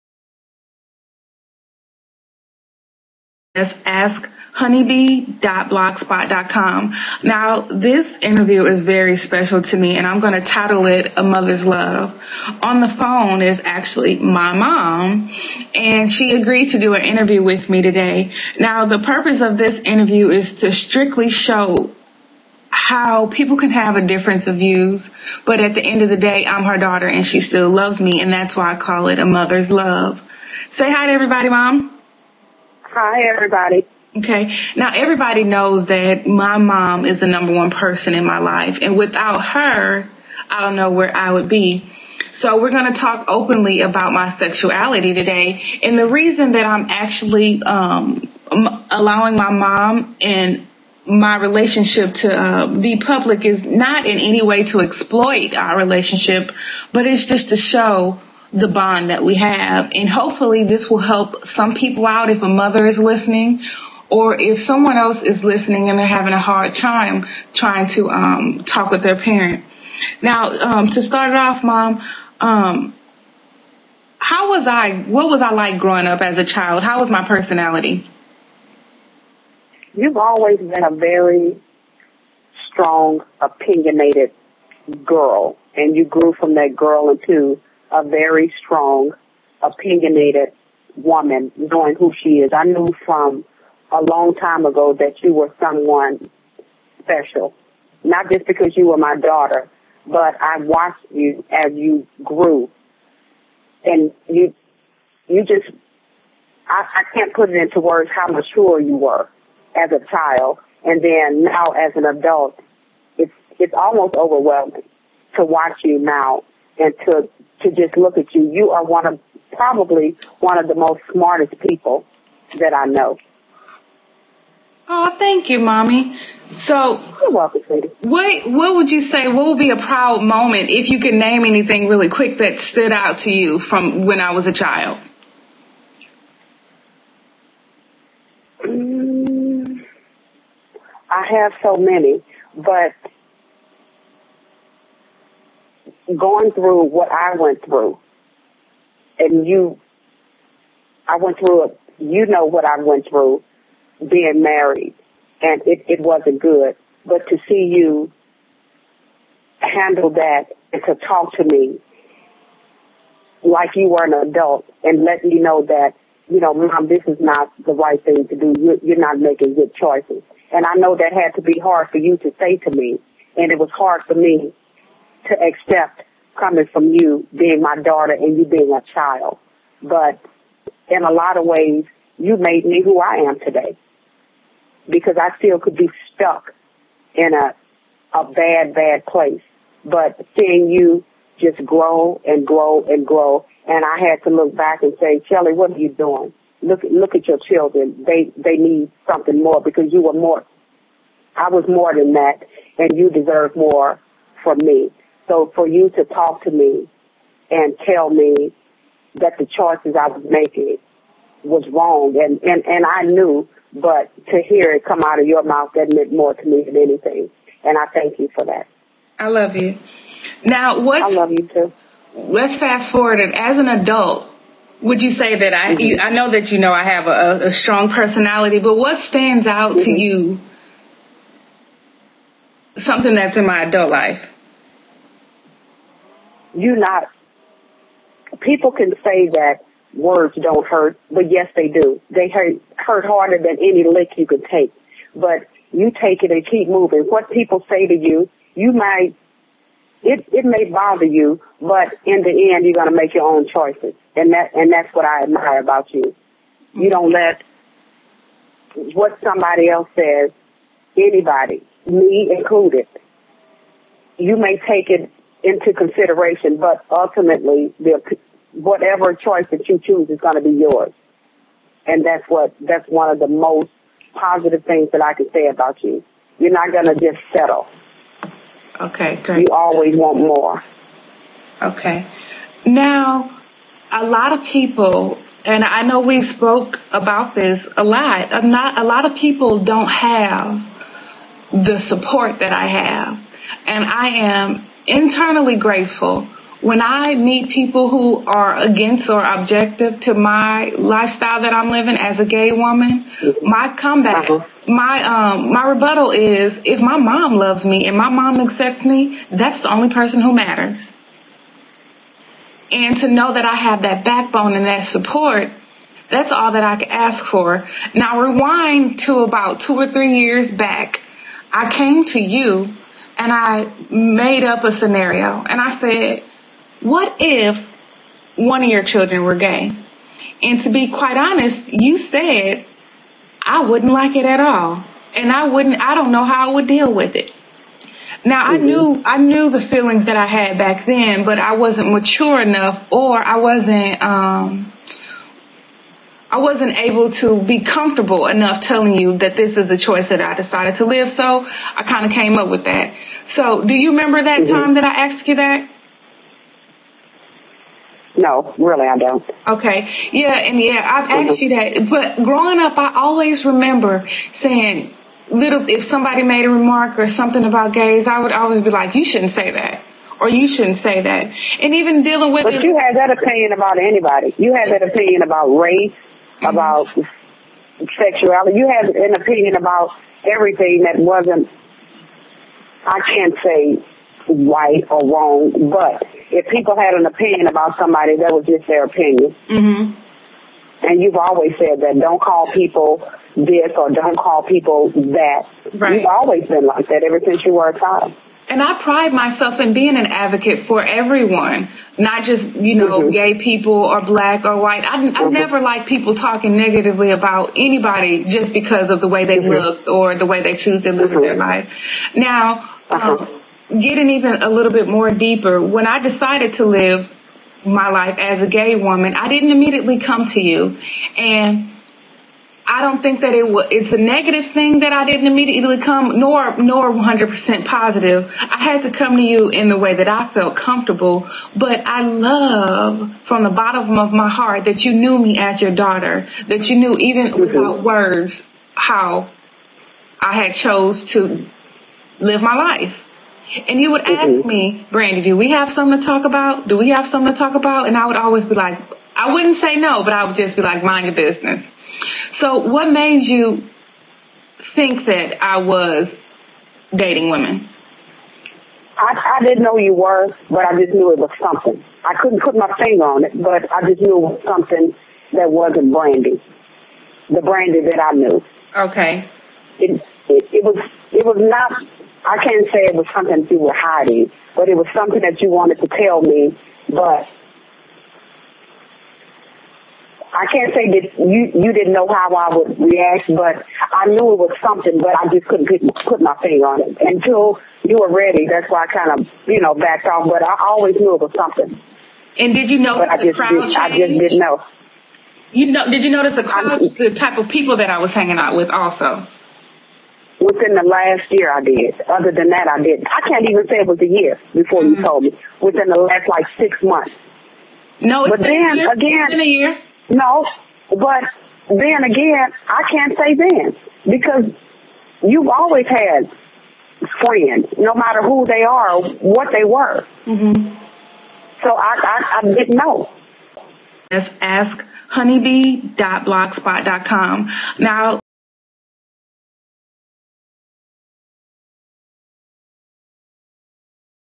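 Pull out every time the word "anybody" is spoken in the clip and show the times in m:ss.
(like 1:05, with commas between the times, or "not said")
4:20, 6:13, 6:47.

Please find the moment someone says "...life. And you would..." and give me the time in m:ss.
7:22.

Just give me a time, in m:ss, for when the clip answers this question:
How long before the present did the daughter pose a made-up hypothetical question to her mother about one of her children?
5:19.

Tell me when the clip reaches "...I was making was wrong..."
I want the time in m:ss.
3:29.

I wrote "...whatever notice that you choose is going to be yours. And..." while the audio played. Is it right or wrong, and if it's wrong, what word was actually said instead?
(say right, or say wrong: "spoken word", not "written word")
wrong: "choice", not "notice".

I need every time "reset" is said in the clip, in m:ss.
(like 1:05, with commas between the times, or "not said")
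not said.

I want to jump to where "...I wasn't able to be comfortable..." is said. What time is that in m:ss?
5:46.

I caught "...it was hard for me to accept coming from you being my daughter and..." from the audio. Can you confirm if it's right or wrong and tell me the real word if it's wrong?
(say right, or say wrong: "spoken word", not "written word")
right.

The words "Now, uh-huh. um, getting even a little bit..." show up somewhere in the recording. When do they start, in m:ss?
6:52.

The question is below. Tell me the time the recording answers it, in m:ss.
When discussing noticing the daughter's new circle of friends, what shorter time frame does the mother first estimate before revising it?
8:26.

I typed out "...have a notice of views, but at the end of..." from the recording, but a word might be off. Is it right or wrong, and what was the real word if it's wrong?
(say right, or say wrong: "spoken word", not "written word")
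wrong: "difference", not "notice".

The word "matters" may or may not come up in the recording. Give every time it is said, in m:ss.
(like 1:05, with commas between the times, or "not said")
5:10, 8:37.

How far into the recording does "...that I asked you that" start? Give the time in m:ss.
5:54.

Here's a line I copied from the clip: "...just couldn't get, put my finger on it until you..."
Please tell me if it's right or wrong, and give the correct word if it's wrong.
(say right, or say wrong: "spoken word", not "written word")
right.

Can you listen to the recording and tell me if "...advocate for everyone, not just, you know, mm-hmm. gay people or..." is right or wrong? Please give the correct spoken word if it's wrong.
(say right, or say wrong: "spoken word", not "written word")
right.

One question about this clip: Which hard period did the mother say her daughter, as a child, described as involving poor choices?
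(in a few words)
being married.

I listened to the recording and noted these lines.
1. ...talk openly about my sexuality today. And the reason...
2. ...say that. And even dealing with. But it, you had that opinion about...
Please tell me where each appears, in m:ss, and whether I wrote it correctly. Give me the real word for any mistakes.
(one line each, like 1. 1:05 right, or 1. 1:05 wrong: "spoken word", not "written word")
1. 0:42 right
2. 6:10 right.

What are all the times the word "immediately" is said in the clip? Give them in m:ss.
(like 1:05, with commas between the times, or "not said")
6:59, 7:05.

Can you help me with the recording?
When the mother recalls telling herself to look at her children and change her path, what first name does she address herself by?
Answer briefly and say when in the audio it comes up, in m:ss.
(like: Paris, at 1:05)
Shelly, at 3:15.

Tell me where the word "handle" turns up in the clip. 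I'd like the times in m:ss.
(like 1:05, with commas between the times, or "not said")
2:39.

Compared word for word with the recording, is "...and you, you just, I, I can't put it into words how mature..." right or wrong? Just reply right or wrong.
right.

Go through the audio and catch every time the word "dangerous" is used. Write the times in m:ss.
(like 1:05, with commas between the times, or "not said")
not said.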